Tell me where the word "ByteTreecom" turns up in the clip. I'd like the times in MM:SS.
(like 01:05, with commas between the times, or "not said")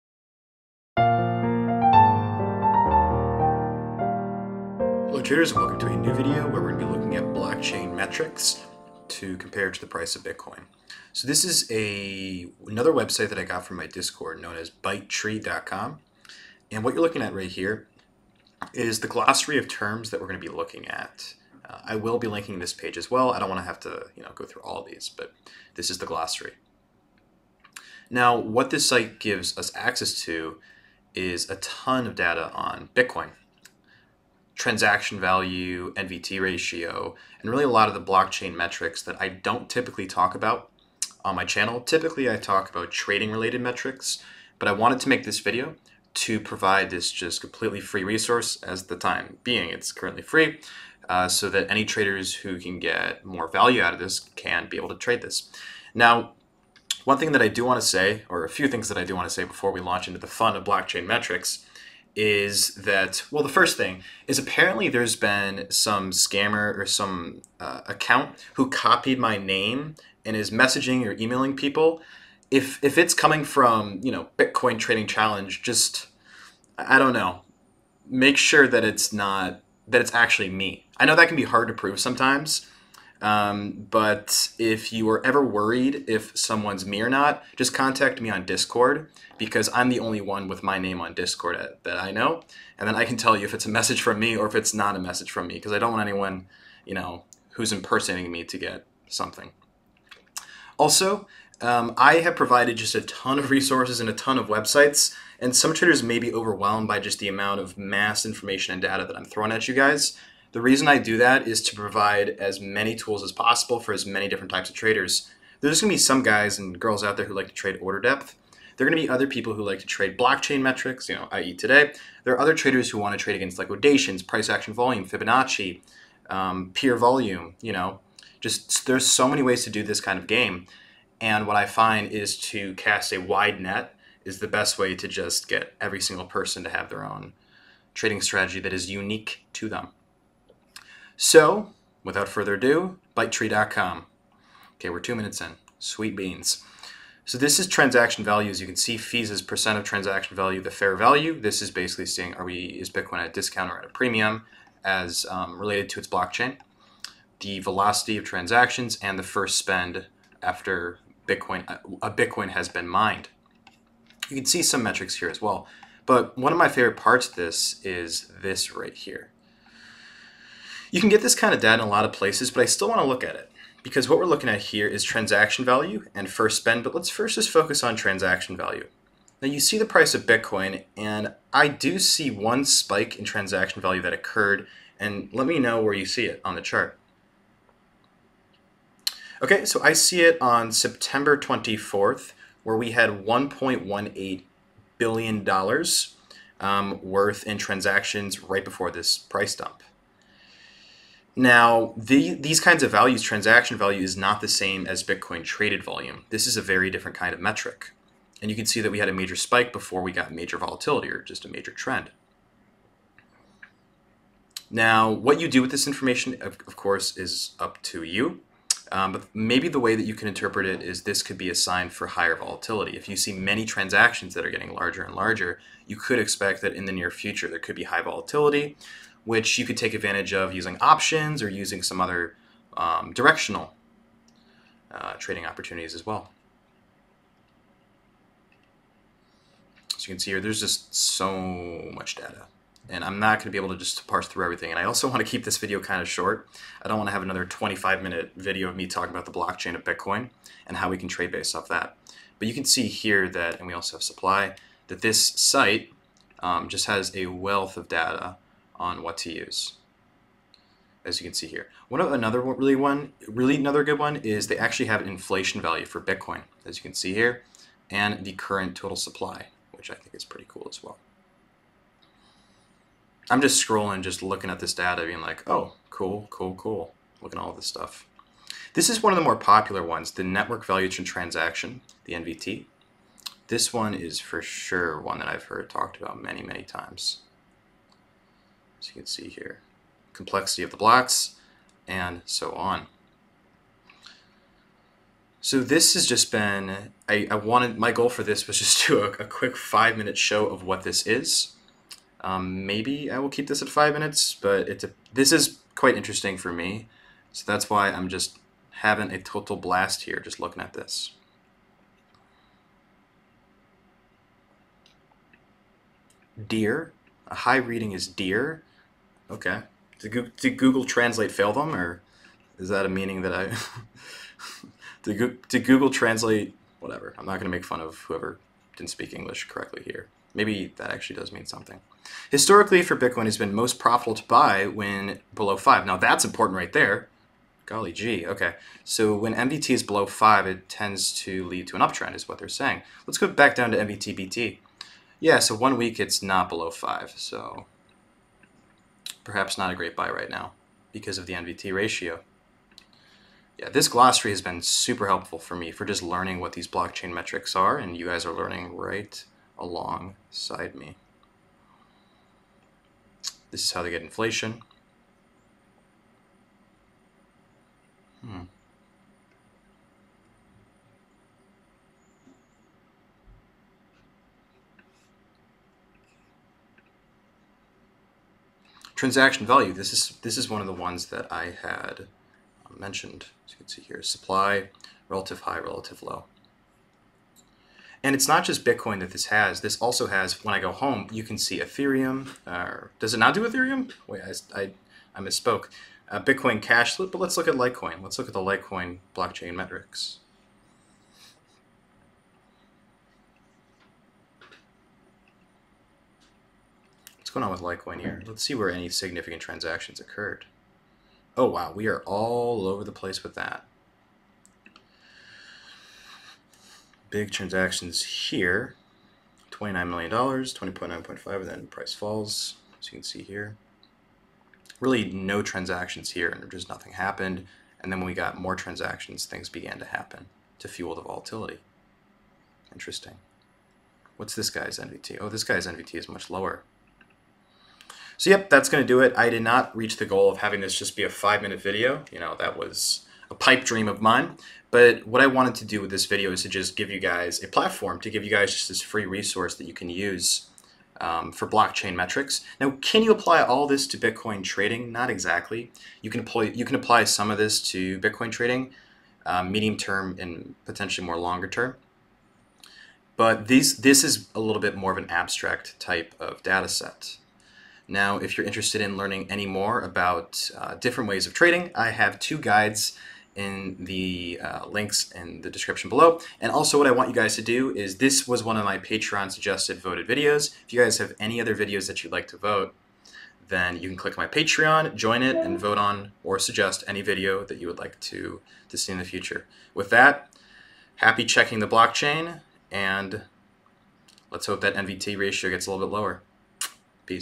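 00:14, 02:23.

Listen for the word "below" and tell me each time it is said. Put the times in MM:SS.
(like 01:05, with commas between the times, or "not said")
05:35, 05:39, 05:46, 07:55.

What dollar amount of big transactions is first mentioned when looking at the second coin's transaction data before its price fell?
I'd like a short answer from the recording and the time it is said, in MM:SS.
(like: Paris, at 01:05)
$29 million, at 06:59.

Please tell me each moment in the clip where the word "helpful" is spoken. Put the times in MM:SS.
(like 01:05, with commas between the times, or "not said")
05:55.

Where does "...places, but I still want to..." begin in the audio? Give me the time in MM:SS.
02:52.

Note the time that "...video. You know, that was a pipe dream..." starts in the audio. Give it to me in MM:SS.
07:21.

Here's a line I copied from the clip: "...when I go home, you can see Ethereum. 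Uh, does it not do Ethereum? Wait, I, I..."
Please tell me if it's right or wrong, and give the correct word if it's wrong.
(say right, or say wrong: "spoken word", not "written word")
right.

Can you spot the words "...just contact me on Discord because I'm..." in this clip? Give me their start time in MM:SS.
01:27.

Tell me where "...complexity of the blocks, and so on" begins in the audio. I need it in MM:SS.
04:50.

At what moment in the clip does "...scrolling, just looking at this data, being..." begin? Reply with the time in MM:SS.
04:33.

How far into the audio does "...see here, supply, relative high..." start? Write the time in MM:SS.
06:23.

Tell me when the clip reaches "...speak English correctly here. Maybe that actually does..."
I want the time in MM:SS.
05:28.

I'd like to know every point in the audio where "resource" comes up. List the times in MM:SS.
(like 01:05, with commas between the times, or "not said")
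00:48, 01:43, 07:29.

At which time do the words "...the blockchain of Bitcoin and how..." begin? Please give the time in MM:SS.
04:09.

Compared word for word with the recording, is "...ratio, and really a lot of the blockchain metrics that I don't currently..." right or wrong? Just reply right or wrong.
wrong.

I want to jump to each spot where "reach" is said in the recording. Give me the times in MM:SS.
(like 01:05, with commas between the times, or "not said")
07:19.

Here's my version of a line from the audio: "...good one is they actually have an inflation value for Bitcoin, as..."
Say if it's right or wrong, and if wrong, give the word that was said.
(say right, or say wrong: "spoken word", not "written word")
right.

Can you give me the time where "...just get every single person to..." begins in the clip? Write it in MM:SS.
02:15.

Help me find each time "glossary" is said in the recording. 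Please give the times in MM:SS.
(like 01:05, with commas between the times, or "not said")
00:19, 00:26, 05:53.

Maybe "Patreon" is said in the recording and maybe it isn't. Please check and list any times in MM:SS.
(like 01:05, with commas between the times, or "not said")
07:58, 08:04.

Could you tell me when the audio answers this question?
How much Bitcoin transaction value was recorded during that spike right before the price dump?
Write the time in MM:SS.
03:13.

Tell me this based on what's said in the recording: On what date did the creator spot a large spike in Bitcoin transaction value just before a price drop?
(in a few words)
September 24th.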